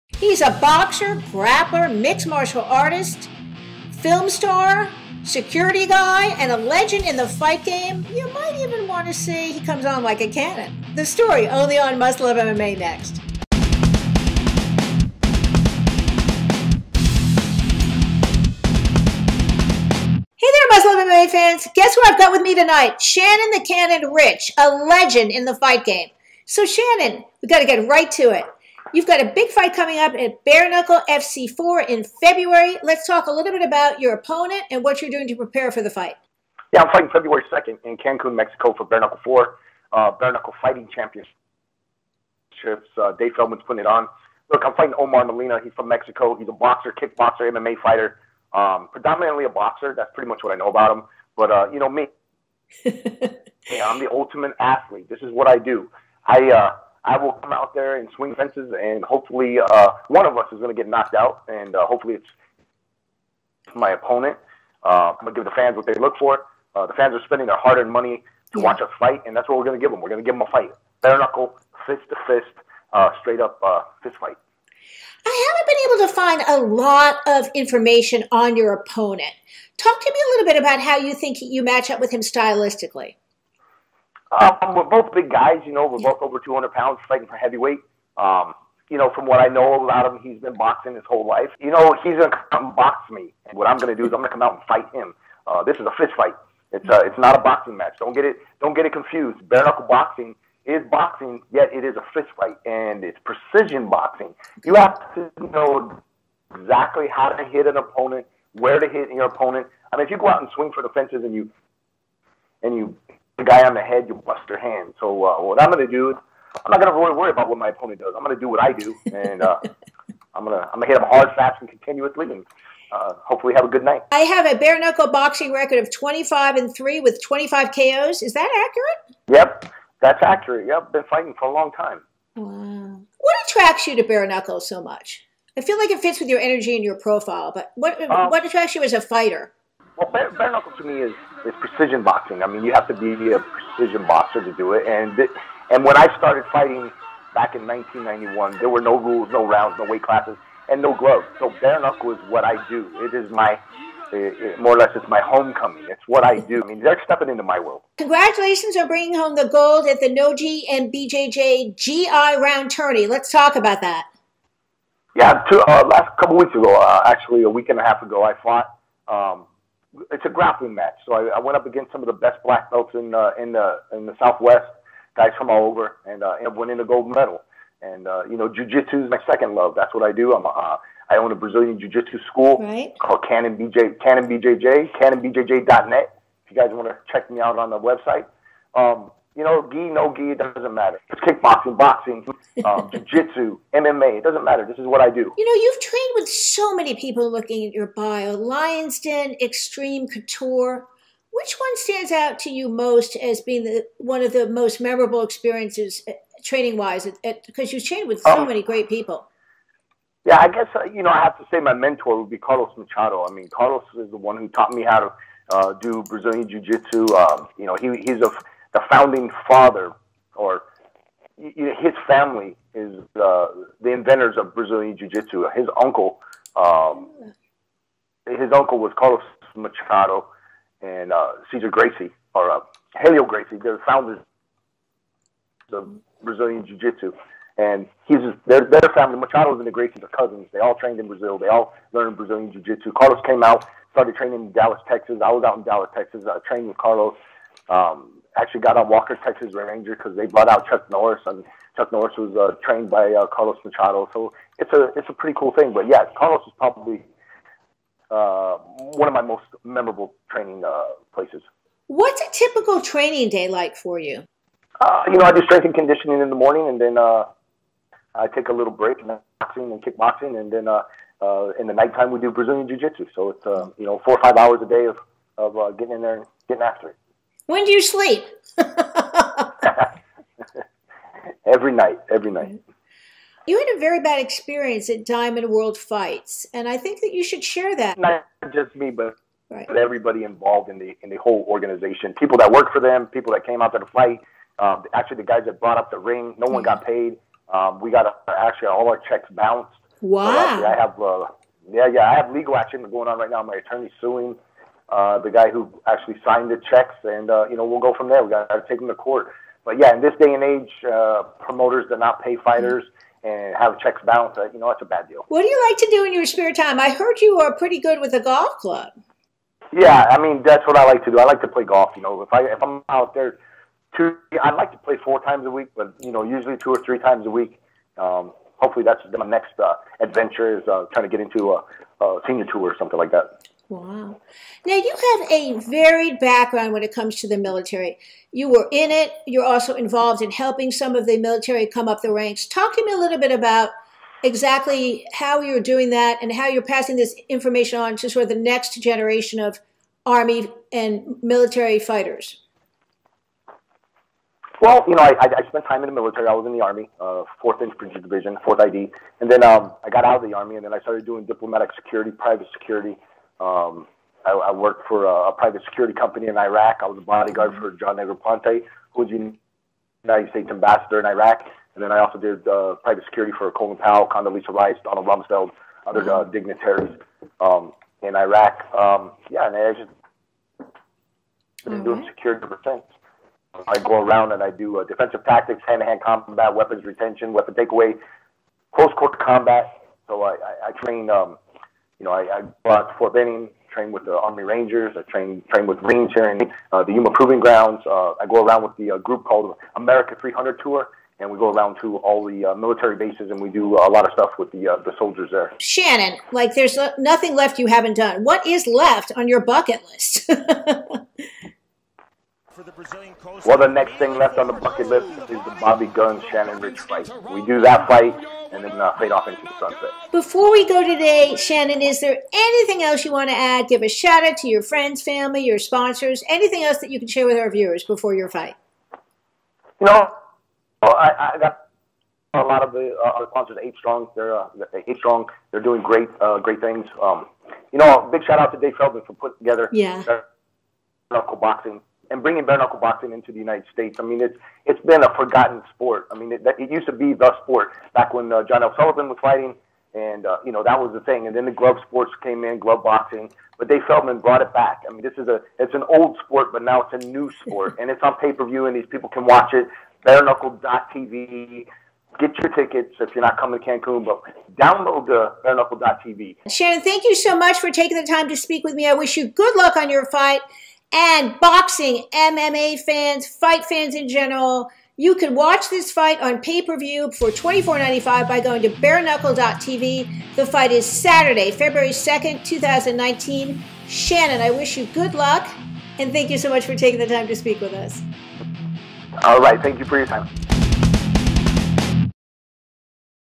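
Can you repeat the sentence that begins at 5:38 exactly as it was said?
You were in it, you're also involved in helping some of the military come up the ranks.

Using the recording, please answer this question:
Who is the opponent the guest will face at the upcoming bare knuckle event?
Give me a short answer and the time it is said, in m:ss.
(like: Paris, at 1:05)
Omar Molina, at 0:44.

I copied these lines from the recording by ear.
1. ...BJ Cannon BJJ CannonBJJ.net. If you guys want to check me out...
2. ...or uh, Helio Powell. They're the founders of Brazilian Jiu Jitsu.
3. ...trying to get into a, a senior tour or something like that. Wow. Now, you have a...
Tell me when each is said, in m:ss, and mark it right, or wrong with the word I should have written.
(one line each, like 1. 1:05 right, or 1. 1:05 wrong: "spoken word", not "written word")
1. 3:03 right
2. 3:52 wrong: "Gracie", not "Powell"
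3. 5:30 right.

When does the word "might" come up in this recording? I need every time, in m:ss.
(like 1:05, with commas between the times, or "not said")
0:08.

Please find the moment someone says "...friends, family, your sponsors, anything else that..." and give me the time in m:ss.
7:04.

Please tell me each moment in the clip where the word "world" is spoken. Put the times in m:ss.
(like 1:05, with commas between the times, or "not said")
2:37, 4:45.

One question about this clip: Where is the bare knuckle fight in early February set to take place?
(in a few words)
Cancun, Mexico.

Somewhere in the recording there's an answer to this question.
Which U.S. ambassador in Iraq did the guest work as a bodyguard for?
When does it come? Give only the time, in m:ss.
6:07.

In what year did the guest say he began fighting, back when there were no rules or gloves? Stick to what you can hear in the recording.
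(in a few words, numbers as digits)
1991.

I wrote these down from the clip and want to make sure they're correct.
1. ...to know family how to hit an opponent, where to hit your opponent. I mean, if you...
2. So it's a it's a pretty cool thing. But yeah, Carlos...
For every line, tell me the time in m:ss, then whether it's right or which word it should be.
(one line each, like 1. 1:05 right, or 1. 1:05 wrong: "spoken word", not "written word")
1. 1:45 wrong: "exactly", not "family"
2. 4:14 right.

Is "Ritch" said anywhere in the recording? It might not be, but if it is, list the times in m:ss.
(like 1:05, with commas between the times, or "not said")
0:24, 6:56.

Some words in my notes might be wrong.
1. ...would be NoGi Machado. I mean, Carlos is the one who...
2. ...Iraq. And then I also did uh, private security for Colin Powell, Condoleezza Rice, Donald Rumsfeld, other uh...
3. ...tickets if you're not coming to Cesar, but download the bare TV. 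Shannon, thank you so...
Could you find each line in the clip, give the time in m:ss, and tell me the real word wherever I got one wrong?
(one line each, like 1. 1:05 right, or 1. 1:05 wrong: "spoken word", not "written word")
1. 3:32 wrong: "Carlos", not "NoGi"
2. 6:11 right
3. 7:42 wrong: "Cancun", not "Cesar".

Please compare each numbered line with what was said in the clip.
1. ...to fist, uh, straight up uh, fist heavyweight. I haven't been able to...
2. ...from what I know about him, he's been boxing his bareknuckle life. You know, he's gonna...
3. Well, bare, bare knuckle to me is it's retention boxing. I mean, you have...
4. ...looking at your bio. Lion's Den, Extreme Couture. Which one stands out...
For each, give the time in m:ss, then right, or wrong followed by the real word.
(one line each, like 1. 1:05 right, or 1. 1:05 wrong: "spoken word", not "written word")
1. 1:12 wrong: "fight", not "heavyweight"
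2. 1:29 wrong: "whole", not "bareknuckle"
3. 2:19 wrong: "precision", not "retention"
4. 3:17 right.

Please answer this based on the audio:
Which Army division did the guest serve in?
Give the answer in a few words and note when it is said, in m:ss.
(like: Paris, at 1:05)
4th Infantry Division, at 5:57.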